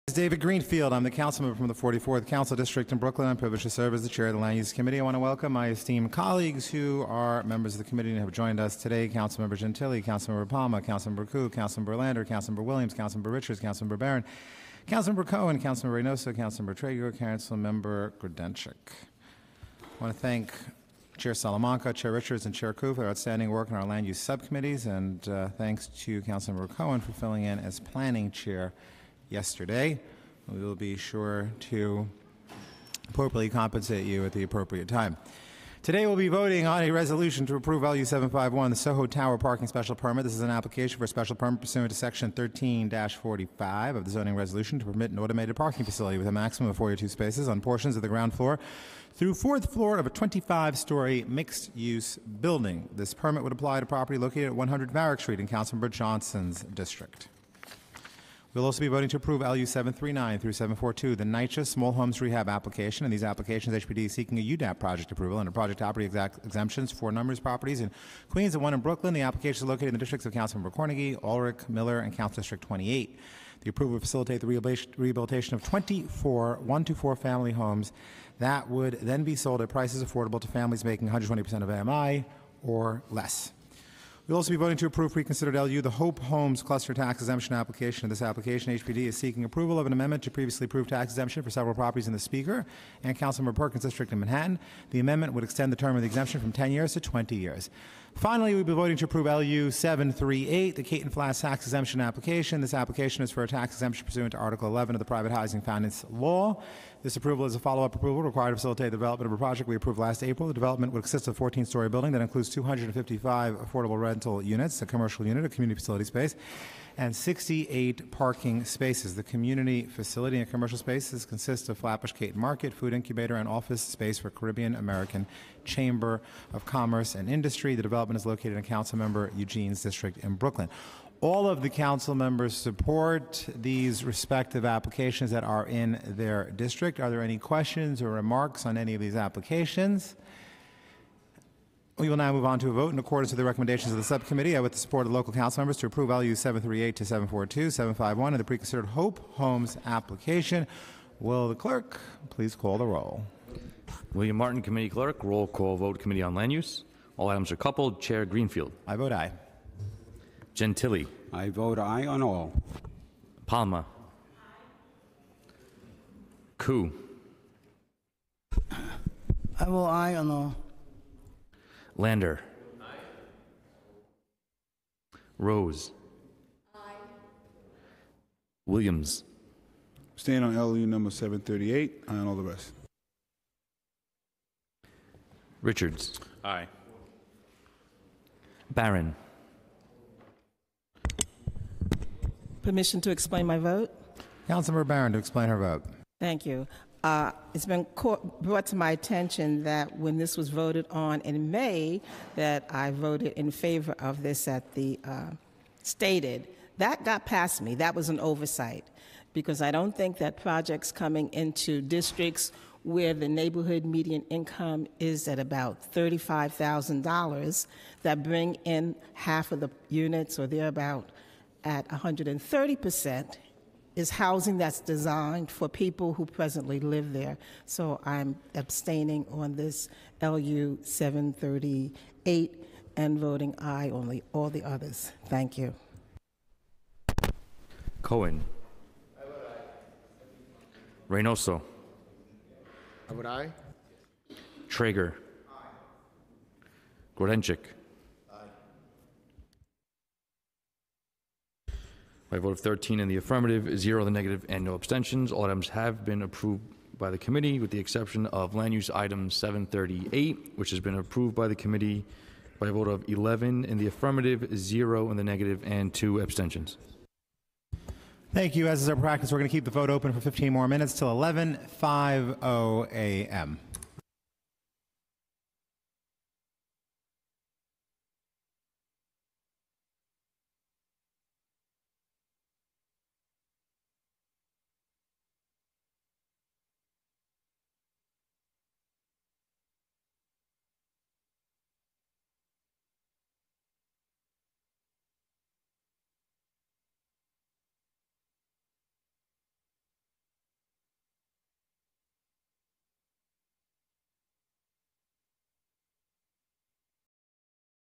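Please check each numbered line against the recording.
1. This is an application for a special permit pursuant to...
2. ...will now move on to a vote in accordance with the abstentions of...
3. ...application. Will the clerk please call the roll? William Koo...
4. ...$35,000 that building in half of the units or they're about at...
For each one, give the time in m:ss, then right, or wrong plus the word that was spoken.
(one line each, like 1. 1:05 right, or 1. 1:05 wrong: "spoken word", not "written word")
1. 0:40 right
2. 2:22 wrong: "recommendations", not "abstentions"
3. 2:29 wrong: "Martin", not "Koo"
4. 3:35 wrong: "bring", not "building".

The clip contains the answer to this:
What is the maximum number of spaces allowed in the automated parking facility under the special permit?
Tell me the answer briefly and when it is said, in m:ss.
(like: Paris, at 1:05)
42, at 0:46.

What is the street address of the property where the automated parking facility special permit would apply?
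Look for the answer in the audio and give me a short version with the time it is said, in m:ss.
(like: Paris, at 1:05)
100 Varick Street, at 0:54.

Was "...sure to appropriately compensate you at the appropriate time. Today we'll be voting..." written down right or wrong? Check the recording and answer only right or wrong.
right.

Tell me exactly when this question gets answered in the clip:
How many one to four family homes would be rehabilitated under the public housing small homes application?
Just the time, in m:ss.
1:15.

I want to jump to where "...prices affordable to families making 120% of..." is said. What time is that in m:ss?
1:19.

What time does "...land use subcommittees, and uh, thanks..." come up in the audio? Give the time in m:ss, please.
0:23.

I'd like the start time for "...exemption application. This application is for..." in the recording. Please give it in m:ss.
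1:41.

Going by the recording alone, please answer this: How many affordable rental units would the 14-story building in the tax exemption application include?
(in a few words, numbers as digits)
255.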